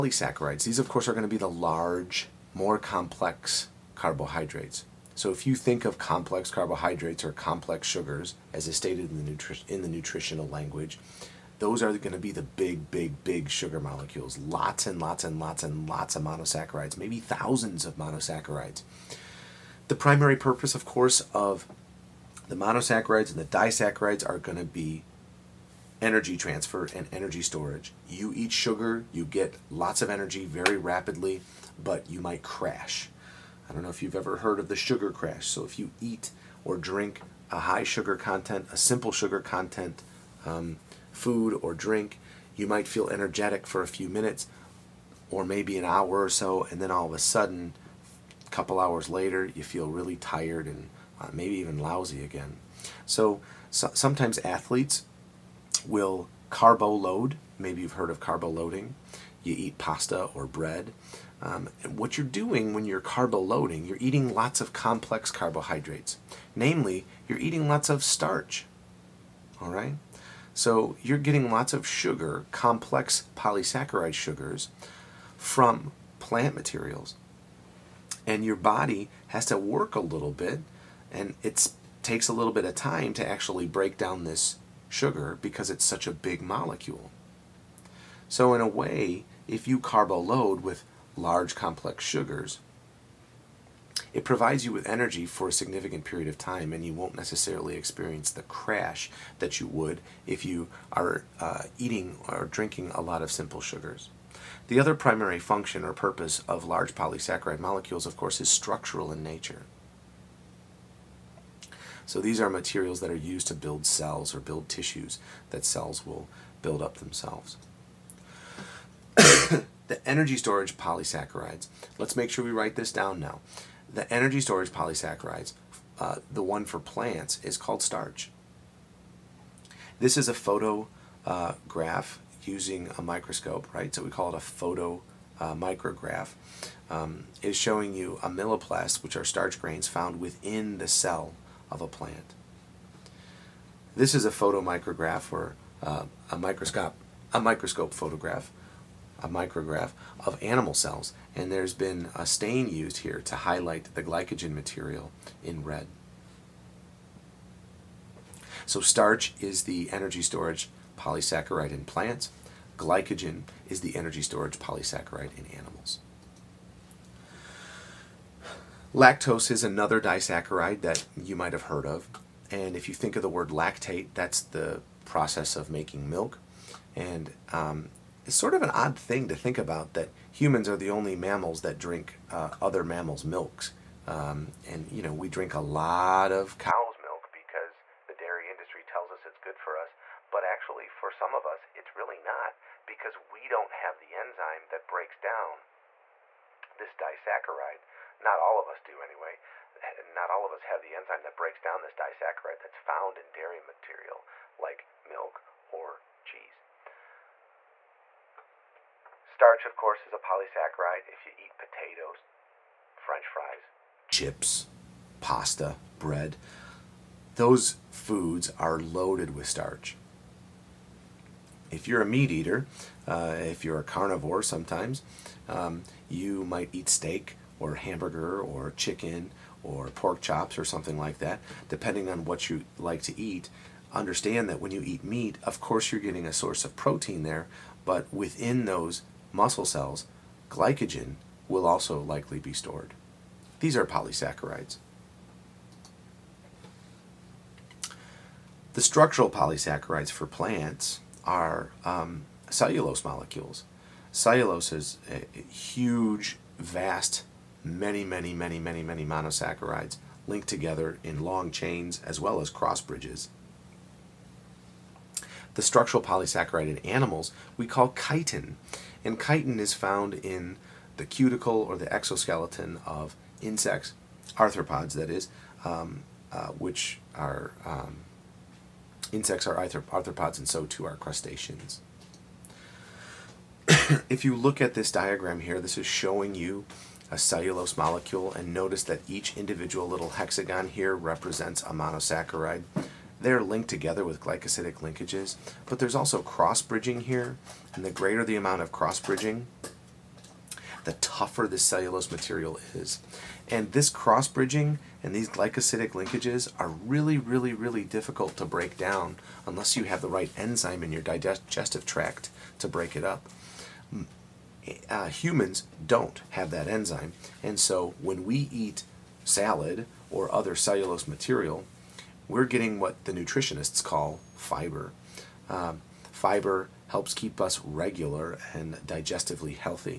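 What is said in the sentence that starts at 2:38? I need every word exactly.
So starch is the energy storage polysaccharide in plants.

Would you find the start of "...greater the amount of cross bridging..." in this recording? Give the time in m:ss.
4:57.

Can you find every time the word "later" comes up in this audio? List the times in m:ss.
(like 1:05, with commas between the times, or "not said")
0:49.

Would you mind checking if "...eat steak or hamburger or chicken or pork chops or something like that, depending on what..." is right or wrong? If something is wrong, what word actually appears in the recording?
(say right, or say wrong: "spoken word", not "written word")
right.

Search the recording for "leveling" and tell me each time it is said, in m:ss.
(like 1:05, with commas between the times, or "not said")
not said.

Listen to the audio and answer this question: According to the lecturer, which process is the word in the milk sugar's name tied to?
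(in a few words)
making milk.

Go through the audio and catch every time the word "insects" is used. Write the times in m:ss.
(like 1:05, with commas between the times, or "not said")
4:33, 4:39.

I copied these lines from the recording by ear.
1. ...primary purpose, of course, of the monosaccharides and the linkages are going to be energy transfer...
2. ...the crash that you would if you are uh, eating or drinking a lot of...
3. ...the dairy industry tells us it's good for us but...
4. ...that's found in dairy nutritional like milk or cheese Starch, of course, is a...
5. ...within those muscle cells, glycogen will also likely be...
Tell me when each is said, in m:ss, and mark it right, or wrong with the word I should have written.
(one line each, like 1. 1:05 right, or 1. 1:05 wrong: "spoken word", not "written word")
1. 0:19 wrong: "disaccharides", not "linkages"
2. 1:38 right
3. 3:08 right
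4. 3:22 wrong: "material", not "nutritional"
5. 3:58 right.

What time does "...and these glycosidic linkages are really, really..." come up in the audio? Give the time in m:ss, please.
5:05.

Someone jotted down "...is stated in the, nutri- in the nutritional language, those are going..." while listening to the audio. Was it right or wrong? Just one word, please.
right.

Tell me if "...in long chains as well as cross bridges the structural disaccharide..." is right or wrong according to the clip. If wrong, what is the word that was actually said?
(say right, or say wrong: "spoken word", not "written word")
wrong: "polysaccharide", not "disaccharide".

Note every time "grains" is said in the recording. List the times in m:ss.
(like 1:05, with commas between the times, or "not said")
2:19.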